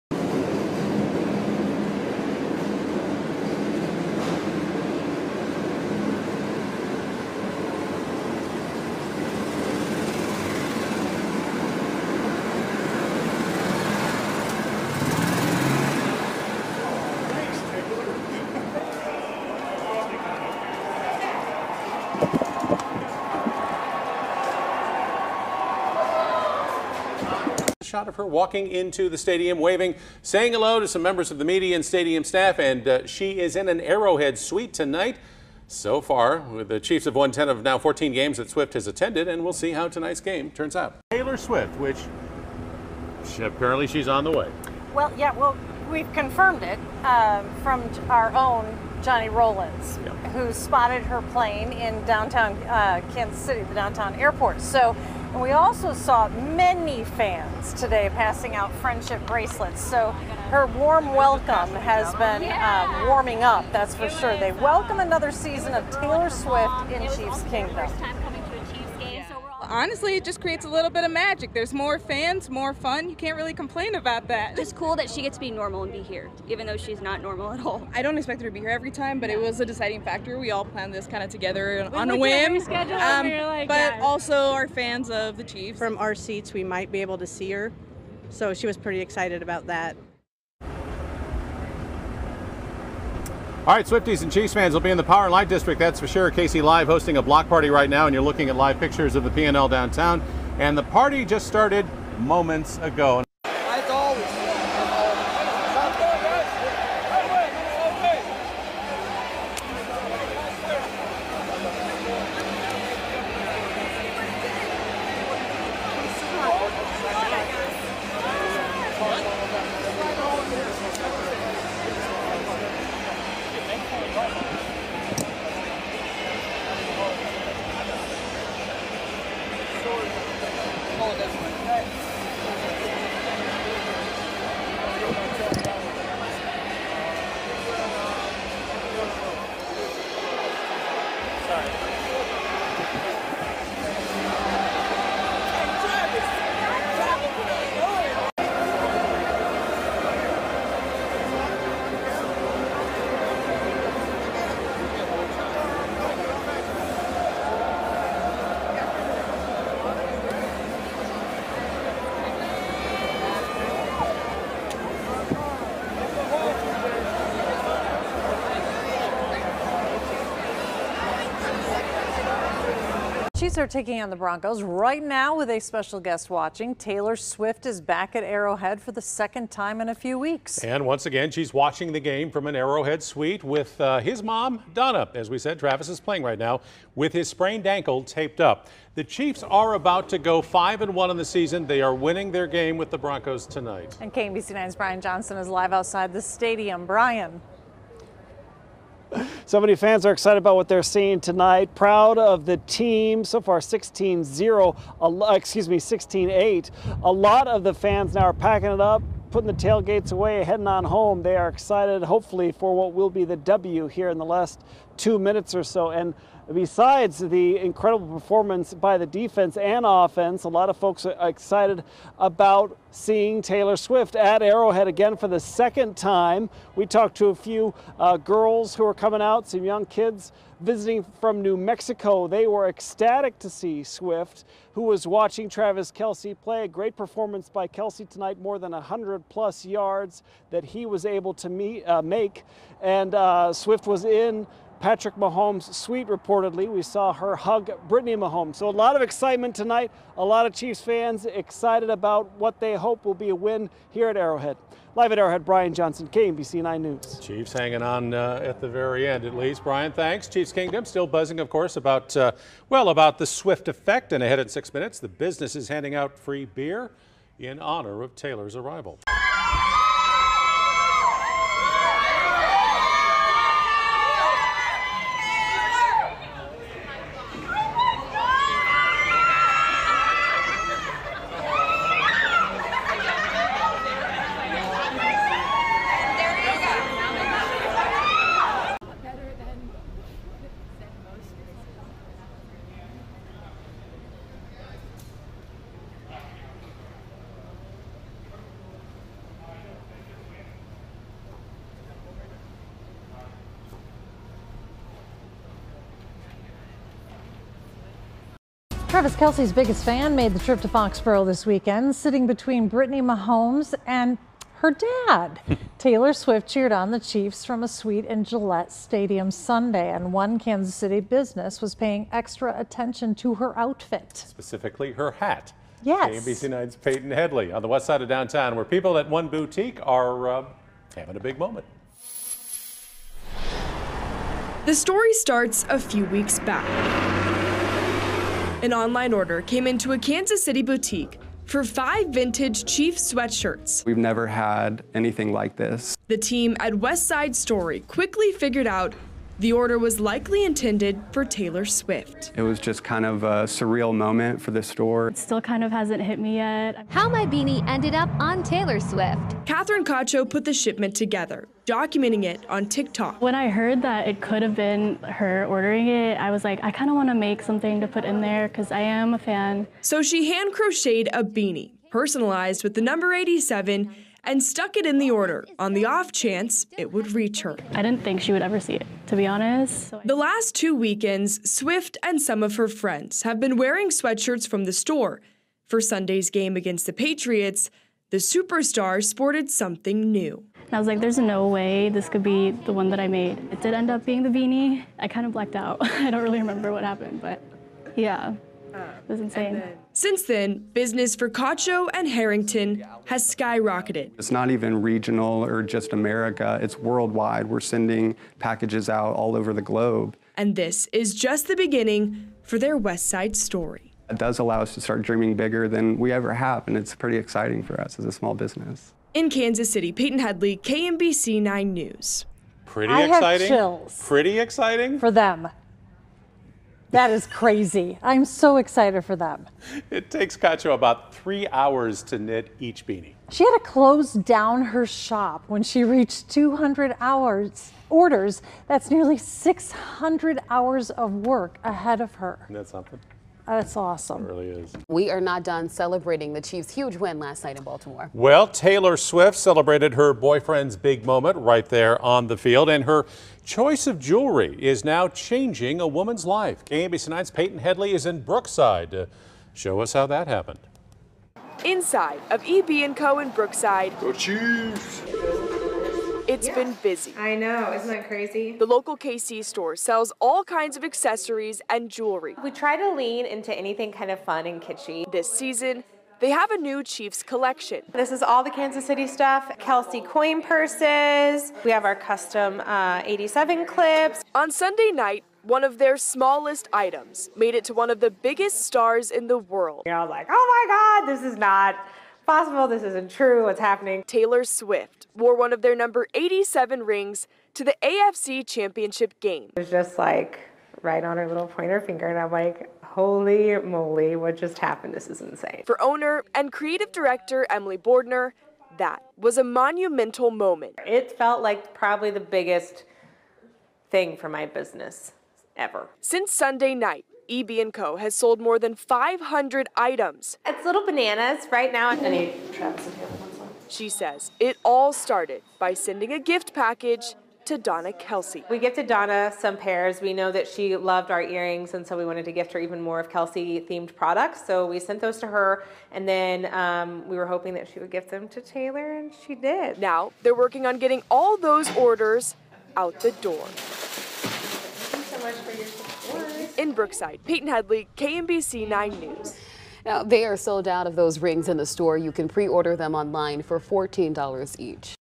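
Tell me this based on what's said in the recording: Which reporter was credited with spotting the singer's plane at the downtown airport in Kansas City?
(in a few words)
Johnny Rollins.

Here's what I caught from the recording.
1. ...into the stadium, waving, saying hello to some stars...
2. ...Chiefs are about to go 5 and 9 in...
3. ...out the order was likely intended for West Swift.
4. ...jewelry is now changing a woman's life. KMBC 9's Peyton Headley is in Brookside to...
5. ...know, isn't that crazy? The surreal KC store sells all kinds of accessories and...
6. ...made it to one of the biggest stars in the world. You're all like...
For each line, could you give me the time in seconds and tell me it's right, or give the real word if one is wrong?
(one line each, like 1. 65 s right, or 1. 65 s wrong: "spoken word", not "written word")
1. 28 s wrong: "members", not "stars"
2. 189 s wrong: "1", not "9"
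3. 348 s wrong: "Taylor", not "West"
4. 453 s right
5. 467 s wrong: "local", not "surreal"
6. 487 s right.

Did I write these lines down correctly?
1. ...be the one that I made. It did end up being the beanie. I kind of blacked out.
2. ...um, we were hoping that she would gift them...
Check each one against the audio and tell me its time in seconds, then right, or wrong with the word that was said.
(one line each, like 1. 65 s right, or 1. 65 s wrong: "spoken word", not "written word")
1. 392 s right
2. 536 s right.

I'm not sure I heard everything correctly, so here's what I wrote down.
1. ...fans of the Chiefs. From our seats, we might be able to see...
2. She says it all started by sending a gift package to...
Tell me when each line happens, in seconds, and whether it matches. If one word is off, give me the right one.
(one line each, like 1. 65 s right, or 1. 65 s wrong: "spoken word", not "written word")
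1. 84 s right
2. 523 s right.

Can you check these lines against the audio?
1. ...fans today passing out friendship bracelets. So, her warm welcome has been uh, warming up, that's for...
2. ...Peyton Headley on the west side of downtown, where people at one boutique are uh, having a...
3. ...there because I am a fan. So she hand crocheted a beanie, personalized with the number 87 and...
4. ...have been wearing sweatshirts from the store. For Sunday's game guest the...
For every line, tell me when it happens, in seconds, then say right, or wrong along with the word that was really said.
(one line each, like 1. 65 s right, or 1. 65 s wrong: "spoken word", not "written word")
1. 57 s right
2. 326 s right
3. 368 s right
4. 383 s wrong: "against", not "guest".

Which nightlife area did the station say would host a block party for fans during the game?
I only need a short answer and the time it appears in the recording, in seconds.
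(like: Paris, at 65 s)
Power and Light District, at 95 s.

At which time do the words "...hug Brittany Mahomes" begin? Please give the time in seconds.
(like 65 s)
247 s.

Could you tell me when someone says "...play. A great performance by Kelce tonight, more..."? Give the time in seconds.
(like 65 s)
236 s.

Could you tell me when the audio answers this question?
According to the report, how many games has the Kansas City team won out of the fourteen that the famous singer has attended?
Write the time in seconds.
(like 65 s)
37 s.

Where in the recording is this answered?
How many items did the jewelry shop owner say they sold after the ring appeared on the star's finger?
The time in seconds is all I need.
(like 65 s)
518 s.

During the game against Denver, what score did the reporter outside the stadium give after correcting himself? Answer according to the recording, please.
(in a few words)
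16-8.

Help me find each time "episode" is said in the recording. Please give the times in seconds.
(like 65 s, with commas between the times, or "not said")
not said.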